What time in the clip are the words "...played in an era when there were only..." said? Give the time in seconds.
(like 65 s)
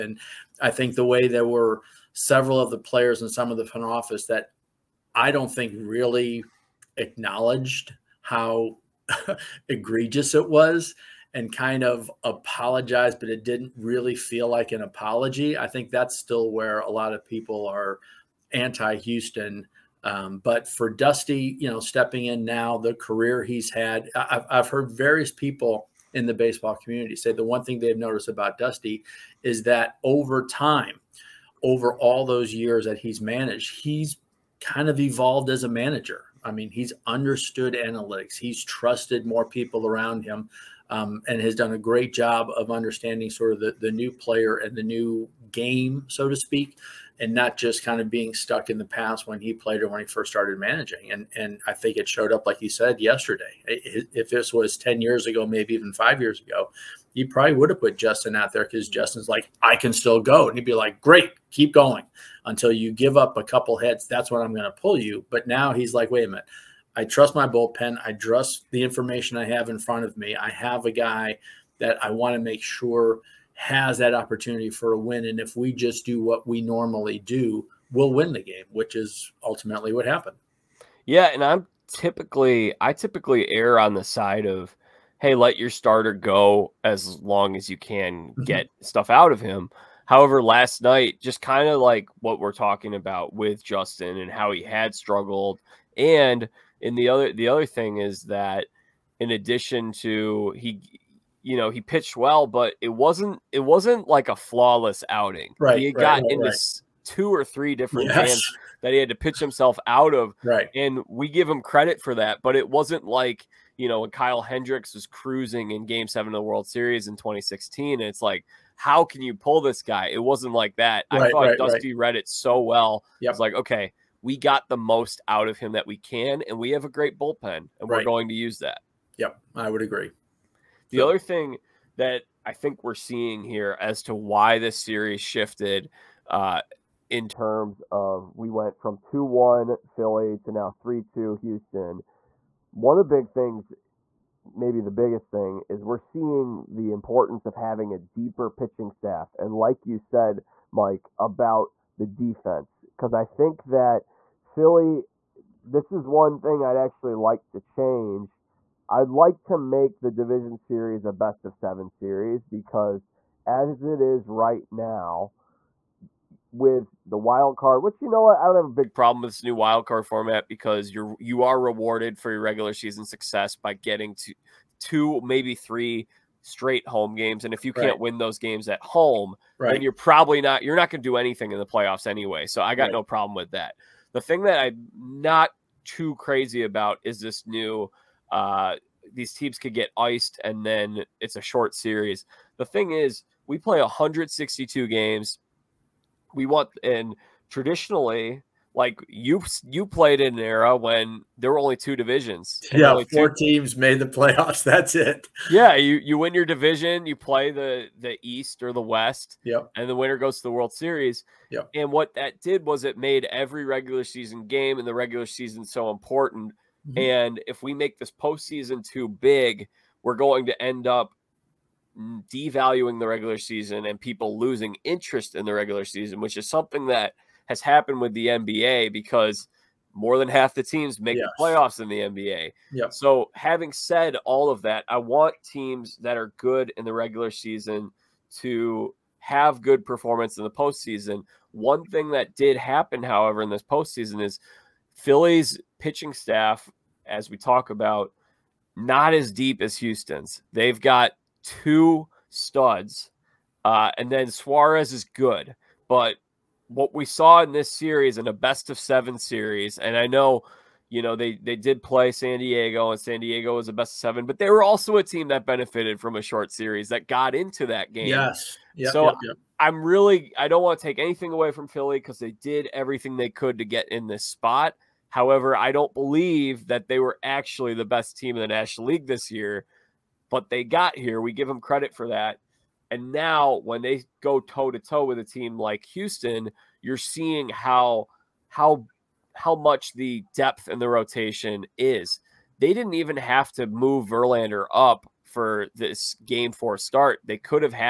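199 s.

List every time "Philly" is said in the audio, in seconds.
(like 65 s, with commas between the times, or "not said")
139 s, 154 s, 244 s, 271 s.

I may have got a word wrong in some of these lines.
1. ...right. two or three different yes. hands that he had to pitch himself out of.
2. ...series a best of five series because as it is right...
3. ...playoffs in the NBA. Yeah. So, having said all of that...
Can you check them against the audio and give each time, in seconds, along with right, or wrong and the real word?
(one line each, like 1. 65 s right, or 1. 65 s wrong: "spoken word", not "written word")
1. 106 s right
2. 160 s wrong: "seven", not "five"
3. 231 s right.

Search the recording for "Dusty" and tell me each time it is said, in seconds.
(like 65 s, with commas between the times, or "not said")
20 s, 28 s, 121 s.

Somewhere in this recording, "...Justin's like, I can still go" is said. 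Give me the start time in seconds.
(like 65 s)
58 s.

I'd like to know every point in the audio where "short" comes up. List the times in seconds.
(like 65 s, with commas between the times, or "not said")
191 s, 266 s.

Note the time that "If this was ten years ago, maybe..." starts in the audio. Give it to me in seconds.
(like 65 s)
53 s.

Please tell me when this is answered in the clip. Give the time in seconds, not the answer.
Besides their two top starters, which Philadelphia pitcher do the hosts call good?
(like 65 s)
254 s.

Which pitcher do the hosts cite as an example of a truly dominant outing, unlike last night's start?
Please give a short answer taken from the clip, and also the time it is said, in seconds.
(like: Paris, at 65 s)
Kyle Hendricks, at 114 s.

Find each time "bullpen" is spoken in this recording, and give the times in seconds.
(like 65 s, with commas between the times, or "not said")
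67 s, 127 s.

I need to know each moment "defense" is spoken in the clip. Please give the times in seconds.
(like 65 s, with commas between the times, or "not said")
152 s.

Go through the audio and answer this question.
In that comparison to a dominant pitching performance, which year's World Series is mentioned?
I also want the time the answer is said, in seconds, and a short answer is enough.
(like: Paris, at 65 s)
2016, at 117 s.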